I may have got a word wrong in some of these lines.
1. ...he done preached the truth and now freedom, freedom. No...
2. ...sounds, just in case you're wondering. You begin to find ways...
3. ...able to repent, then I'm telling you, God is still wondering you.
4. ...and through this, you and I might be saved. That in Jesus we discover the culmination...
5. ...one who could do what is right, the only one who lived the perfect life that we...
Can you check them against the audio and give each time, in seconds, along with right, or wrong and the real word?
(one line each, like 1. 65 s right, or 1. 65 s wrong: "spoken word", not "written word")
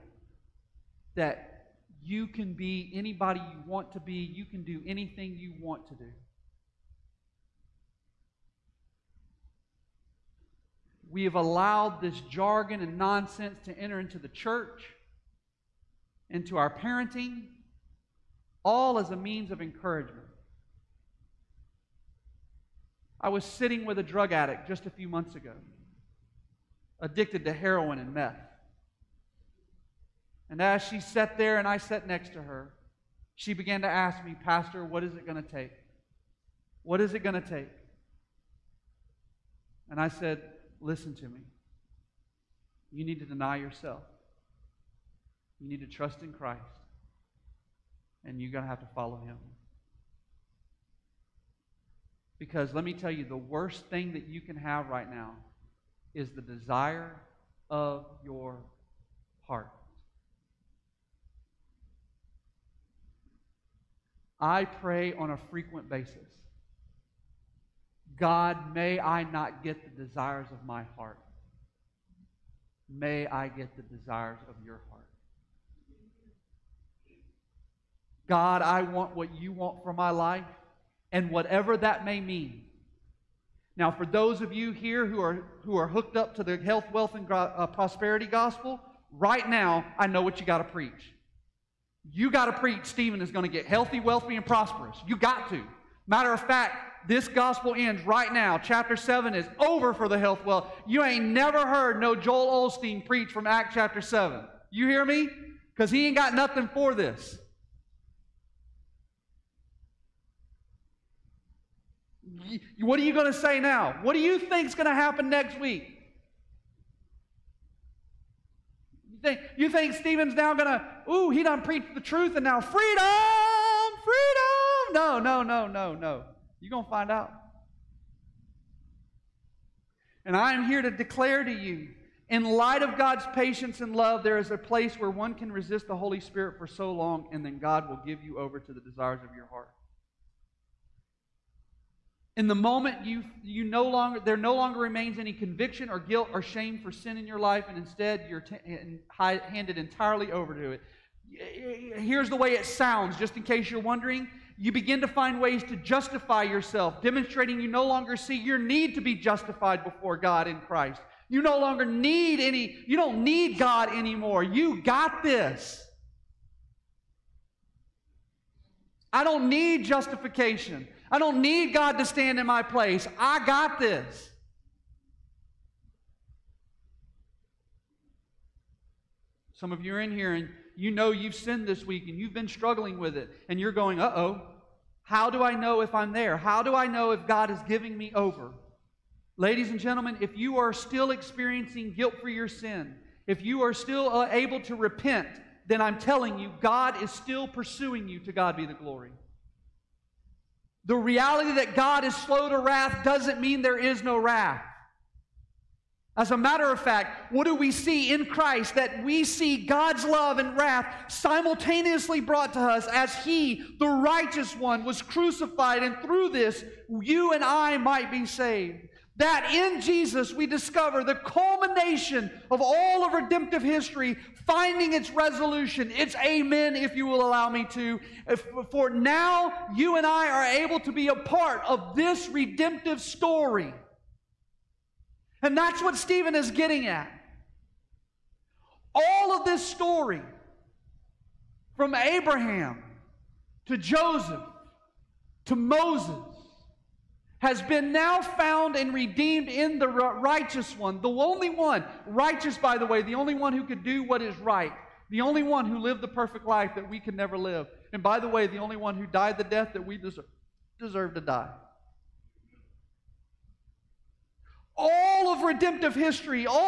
1. 121 s right
2. 152 s right
3. 194 s wrong: "pursuing", not "wondering"
4. 215 s right
5. 253 s right.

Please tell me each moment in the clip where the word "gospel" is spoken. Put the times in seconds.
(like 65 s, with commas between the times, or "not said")
88 s, 97 s.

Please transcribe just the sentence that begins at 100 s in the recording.
You ain't never heard no Joel Osteen preach from Act chapter 7.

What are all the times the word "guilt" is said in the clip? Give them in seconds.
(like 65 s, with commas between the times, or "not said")
145 s, 191 s.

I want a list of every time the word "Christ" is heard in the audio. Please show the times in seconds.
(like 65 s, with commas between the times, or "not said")
46 s, 160 s, 208 s.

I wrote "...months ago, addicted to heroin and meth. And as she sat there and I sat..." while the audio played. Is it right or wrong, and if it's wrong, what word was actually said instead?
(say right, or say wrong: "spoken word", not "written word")
right.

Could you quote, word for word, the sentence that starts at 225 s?
It's amen, if you will allow me to.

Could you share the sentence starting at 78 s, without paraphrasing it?
God, I want what you want for my life and whatever that may mean.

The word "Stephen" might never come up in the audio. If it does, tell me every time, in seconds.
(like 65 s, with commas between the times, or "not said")
92 s, 119 s, 235 s.